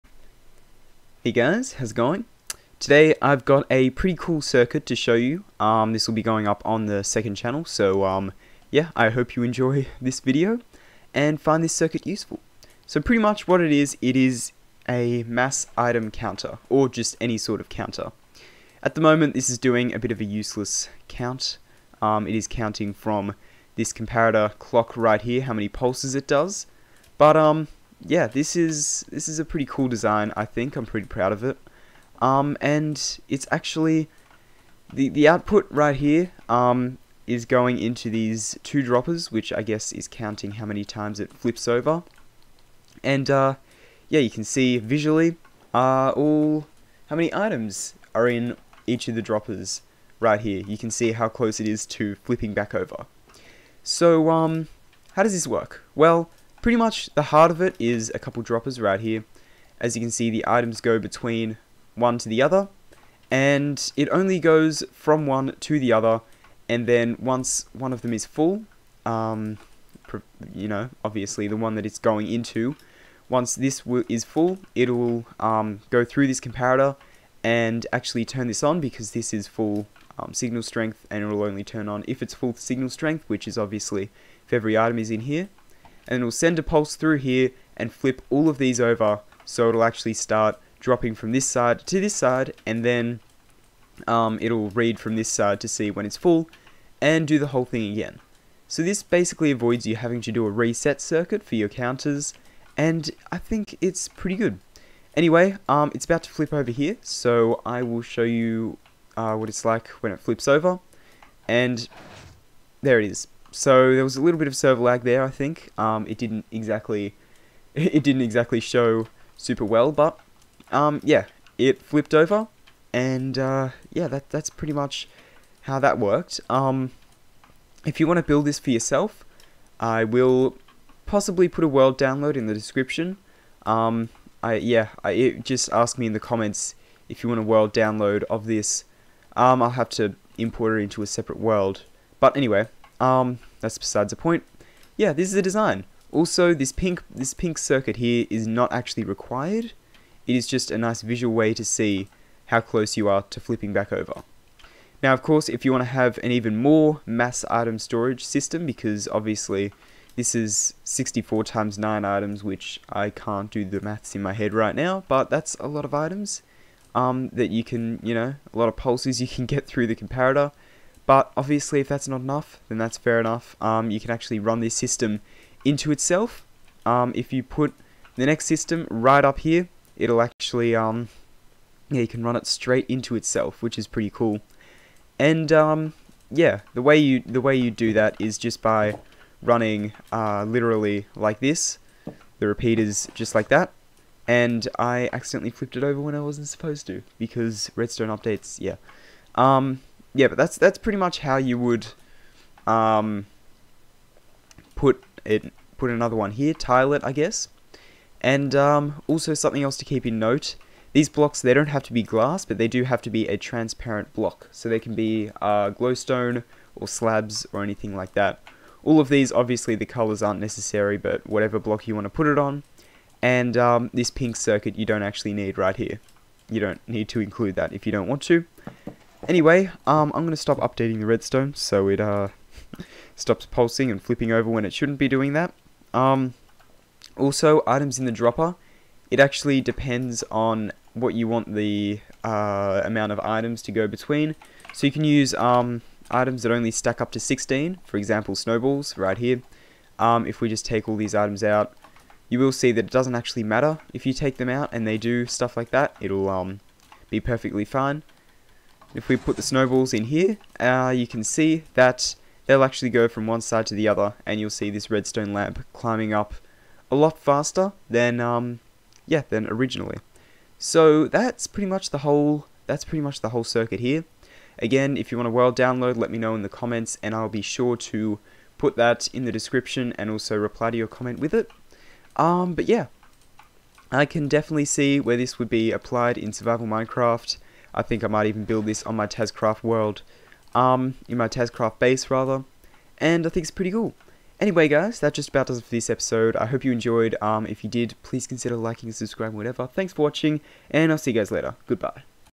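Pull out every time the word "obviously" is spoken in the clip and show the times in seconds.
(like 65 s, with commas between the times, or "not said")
71 s, 83 s, 159 s, 171 s, 219 s.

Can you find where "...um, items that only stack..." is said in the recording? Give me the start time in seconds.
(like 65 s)
245 s.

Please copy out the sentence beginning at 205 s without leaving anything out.
Put another one here, tile it, I guess.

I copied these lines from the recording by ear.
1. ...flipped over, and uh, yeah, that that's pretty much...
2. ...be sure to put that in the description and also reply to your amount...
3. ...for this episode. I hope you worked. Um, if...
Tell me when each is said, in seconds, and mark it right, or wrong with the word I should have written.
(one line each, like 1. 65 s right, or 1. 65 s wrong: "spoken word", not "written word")
1. 121 s right
2. 277 s wrong: "comment", not "amount"
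3. 295 s wrong: "enjoyed", not "worked".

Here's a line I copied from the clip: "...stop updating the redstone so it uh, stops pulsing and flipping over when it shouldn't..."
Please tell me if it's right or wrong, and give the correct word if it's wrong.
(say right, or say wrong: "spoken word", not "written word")
right.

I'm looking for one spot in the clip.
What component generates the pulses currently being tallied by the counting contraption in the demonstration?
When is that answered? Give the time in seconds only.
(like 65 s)
23 s.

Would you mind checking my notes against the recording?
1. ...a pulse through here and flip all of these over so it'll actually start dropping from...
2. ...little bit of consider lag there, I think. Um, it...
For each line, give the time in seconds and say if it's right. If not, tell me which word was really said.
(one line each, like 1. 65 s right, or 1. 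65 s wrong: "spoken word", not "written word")
1. 86 s right
2. 114 s wrong: "server", not "consider".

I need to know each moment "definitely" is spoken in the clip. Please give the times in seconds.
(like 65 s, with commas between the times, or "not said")
284 s.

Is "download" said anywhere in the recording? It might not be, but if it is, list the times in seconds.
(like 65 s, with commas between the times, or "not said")
131 s, 137 s, 275 s.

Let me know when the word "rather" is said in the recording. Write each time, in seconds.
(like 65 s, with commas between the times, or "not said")
292 s.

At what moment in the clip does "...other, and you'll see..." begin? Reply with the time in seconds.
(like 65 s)
263 s.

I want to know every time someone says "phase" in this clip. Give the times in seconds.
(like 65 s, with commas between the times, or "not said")
not said.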